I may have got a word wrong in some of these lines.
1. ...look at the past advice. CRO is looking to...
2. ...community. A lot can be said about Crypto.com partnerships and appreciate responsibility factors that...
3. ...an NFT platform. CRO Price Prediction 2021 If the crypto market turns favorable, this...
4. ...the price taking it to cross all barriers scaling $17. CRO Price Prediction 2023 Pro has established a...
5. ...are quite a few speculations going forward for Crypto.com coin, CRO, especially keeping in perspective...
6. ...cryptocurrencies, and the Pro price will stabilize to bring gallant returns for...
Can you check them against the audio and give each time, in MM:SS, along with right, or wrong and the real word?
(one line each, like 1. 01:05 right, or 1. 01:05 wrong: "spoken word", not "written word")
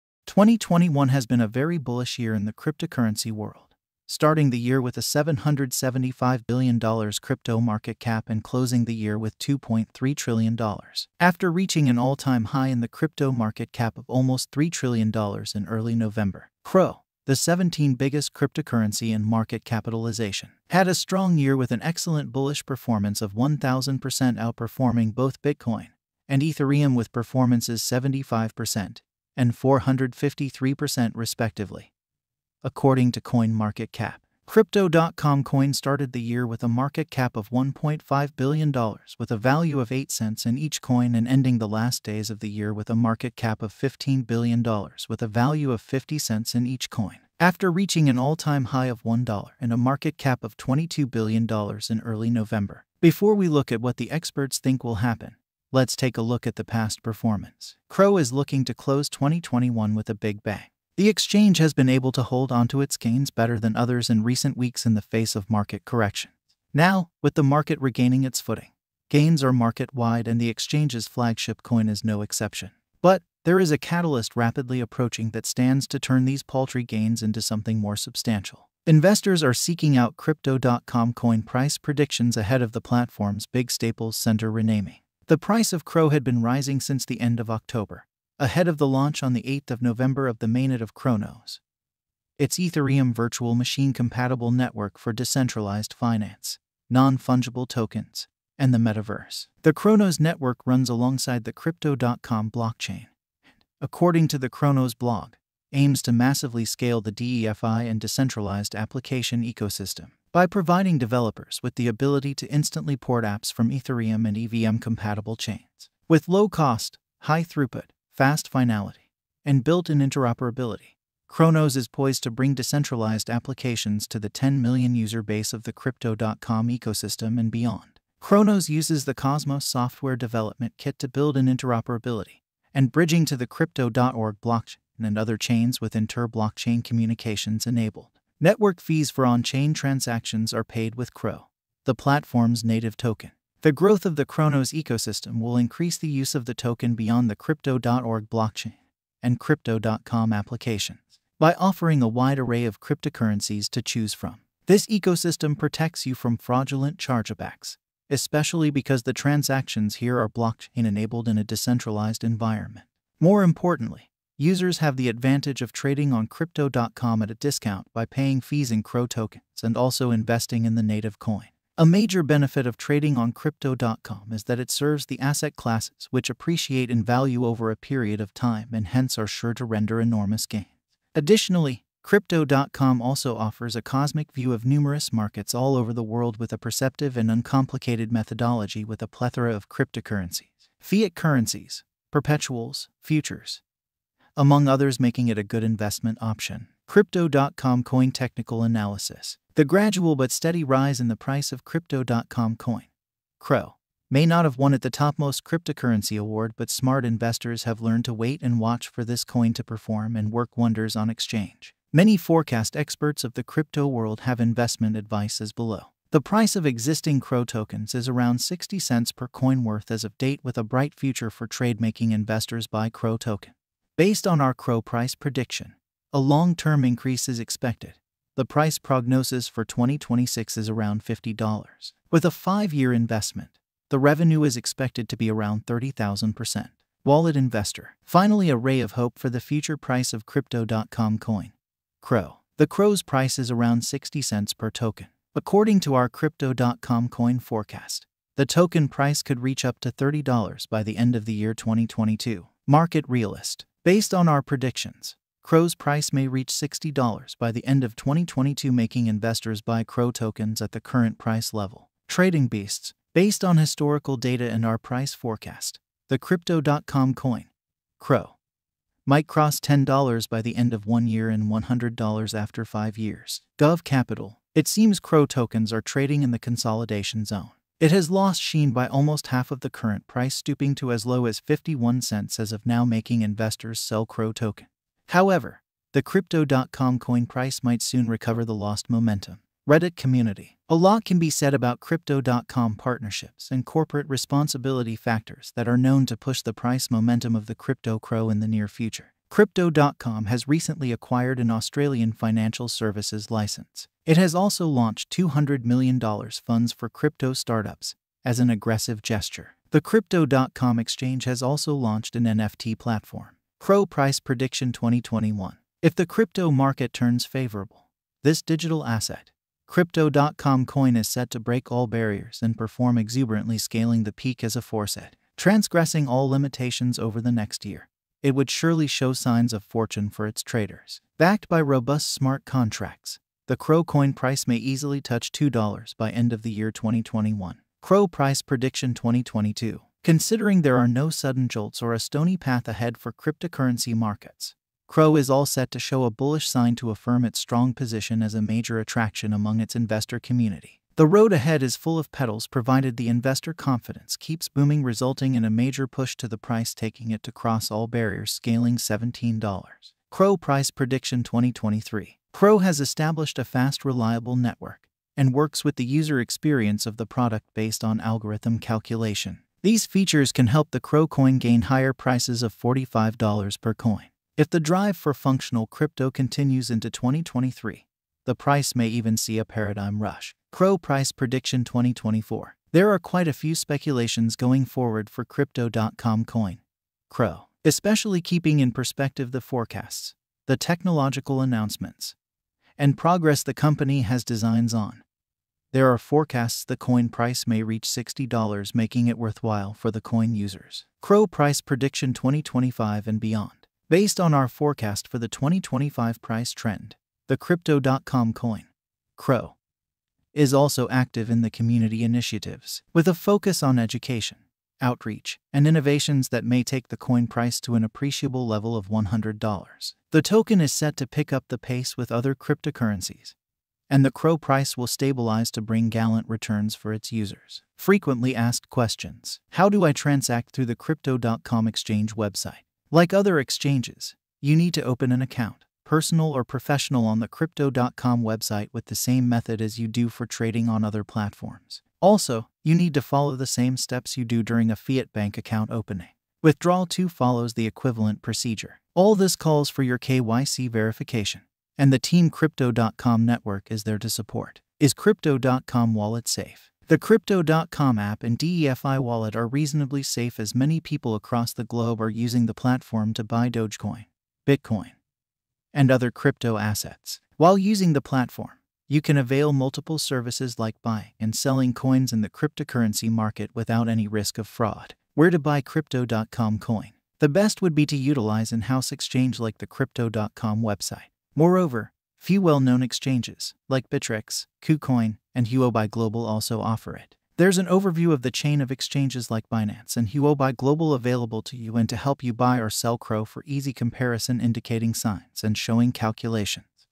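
1. 00:56 wrong: "performance", not "advice"
2. 04:49 wrong: "corporate", not "appreciate"
3. 05:12 right
4. 05:56 right
5. 06:22 right
6. 07:02 wrong: "CRO", not "Pro".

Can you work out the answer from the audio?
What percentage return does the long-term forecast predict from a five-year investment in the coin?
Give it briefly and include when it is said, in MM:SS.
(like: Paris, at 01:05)
30,000%, at 03:55.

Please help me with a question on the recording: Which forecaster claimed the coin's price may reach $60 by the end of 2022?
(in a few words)
Trading Beasts.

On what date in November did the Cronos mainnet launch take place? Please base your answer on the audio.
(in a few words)
8th of November.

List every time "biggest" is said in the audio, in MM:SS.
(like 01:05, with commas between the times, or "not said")
00:17.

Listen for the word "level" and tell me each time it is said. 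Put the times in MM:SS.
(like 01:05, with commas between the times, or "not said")
04:21, 06:58.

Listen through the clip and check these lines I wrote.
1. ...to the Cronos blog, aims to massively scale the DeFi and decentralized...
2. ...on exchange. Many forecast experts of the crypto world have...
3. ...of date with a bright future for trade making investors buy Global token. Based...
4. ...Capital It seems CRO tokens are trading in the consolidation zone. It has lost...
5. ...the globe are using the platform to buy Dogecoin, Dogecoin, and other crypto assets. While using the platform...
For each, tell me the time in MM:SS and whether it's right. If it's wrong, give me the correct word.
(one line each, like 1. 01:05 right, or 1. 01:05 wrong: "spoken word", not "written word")
1. 01:44 right
2. 03:30 right
3. 03:40 wrong: "CRO", not "Global"
4. 04:33 right
5. 07:41 wrong: "Bitcoin", not "Dogecoin".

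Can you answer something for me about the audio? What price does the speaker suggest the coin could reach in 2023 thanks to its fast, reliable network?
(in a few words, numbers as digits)
$45.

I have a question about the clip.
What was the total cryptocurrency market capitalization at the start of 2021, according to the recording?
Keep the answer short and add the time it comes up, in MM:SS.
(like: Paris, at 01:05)
$775 billion, at 00:05.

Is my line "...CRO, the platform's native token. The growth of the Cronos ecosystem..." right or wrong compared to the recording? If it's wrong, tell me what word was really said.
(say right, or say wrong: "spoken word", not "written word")
right.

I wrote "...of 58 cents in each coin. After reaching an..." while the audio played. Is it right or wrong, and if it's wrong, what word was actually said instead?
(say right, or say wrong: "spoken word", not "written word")
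wrong: "50", not "58".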